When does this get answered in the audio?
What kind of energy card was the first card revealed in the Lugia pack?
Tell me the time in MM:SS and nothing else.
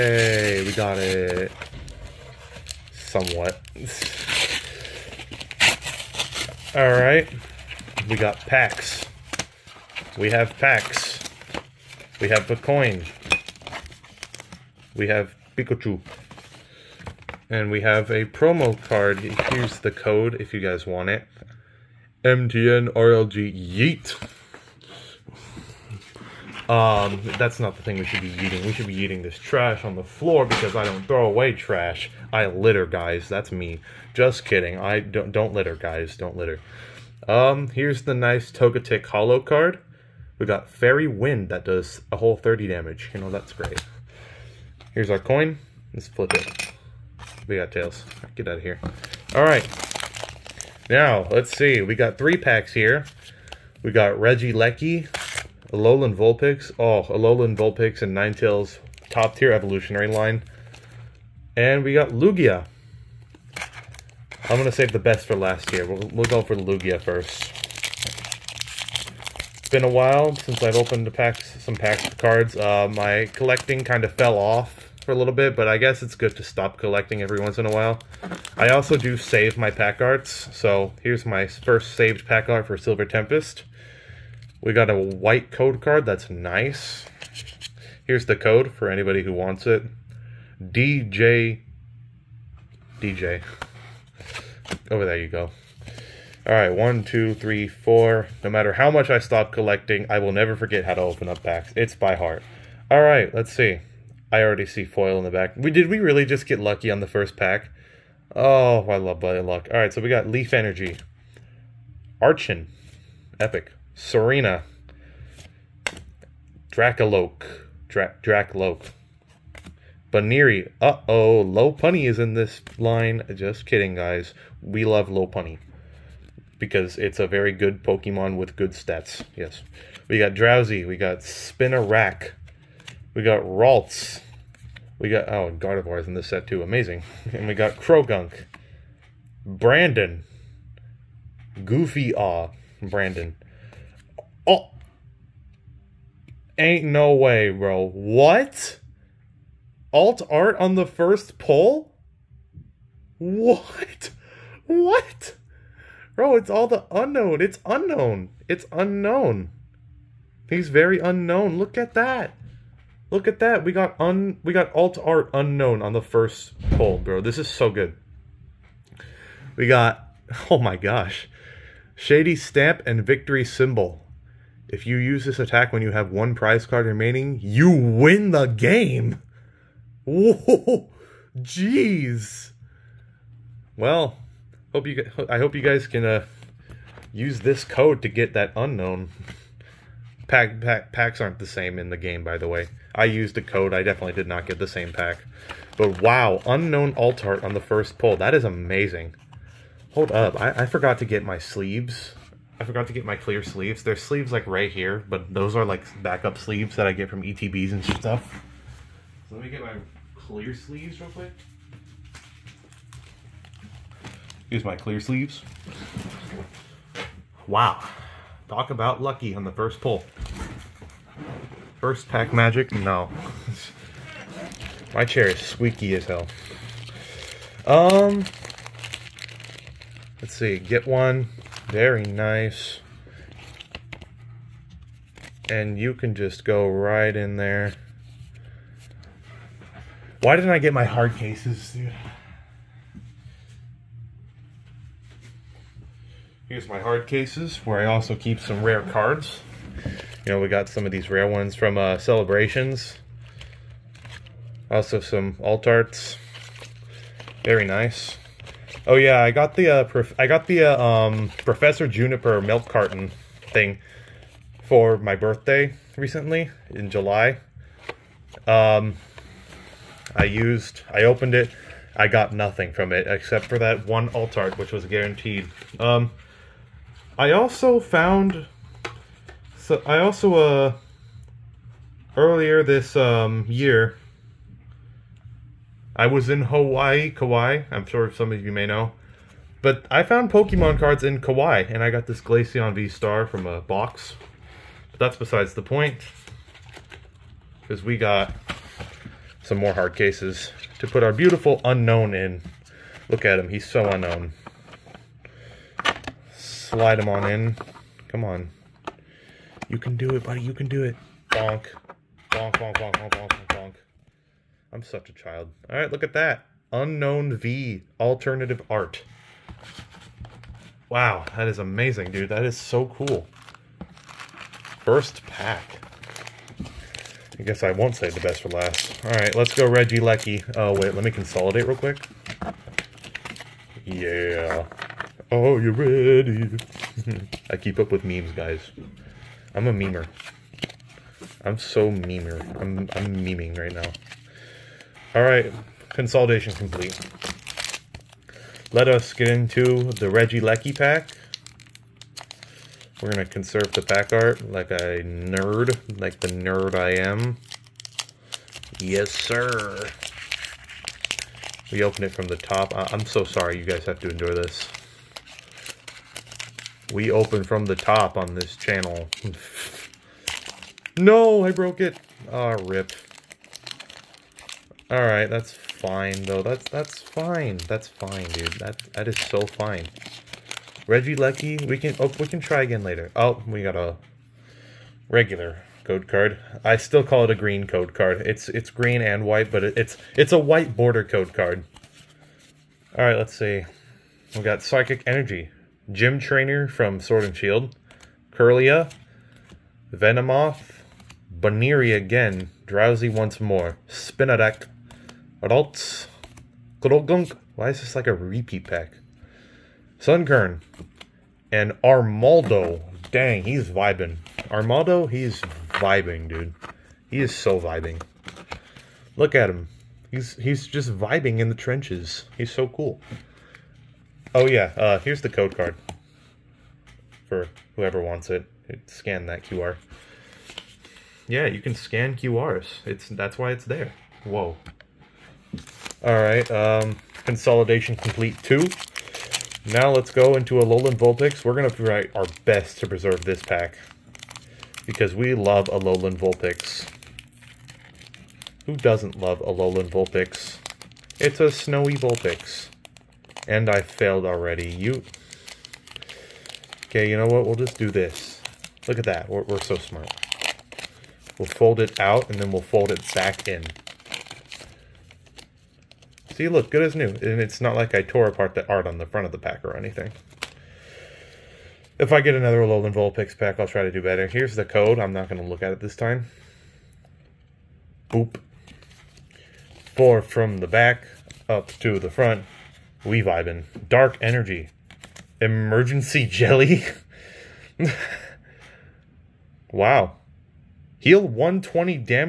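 01:50.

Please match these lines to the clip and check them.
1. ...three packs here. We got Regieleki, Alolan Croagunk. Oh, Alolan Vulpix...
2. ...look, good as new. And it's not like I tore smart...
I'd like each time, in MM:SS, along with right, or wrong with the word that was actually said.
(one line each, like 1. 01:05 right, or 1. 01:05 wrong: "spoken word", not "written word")
1. 00:52 wrong: "Vulpix", not "Croagunk"
2. 07:46 wrong: "apart", not "smart".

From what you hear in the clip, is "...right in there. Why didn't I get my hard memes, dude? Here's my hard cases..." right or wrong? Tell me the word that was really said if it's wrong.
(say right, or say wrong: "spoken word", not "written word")
wrong: "cases", not "memes".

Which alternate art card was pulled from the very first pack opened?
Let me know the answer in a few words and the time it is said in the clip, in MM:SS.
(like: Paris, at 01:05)
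Unknown V, at 05:16.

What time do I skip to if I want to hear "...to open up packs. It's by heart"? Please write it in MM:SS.
01:40.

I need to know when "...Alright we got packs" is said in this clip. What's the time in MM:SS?
00:06.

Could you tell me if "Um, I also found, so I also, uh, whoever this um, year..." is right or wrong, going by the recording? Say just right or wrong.
wrong.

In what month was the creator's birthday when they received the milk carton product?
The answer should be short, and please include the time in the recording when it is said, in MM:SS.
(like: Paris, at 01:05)
July, at 04:26.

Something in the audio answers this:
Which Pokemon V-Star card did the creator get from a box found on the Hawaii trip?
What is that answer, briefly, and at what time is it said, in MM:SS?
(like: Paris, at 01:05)
Glaceon, at 04:52.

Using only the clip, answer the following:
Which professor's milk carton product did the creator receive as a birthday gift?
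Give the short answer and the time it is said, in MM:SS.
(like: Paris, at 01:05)
Professor Juniper, at 04:21.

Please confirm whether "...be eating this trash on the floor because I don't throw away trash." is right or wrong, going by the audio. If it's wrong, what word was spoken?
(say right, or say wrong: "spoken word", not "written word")
right.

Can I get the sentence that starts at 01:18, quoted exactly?
I also do save my pack arts, so here's my first saved pack art for Silver Tempest.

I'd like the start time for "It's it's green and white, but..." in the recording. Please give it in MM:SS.
06:28.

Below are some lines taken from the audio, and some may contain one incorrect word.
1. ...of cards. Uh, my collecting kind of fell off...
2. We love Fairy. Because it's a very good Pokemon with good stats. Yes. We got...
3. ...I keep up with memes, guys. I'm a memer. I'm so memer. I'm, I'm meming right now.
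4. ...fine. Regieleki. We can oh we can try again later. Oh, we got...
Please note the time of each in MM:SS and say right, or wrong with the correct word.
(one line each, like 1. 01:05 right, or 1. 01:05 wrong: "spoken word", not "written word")
1. 01:12 right
2. 02:04 wrong: "Lopunny", not "Fairy"
3. 05:37 right
4. 06:19 right.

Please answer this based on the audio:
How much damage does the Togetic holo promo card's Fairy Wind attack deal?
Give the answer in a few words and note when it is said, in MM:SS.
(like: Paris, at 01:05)
30, at 00:42.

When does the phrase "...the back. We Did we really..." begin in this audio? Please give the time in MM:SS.
01:45.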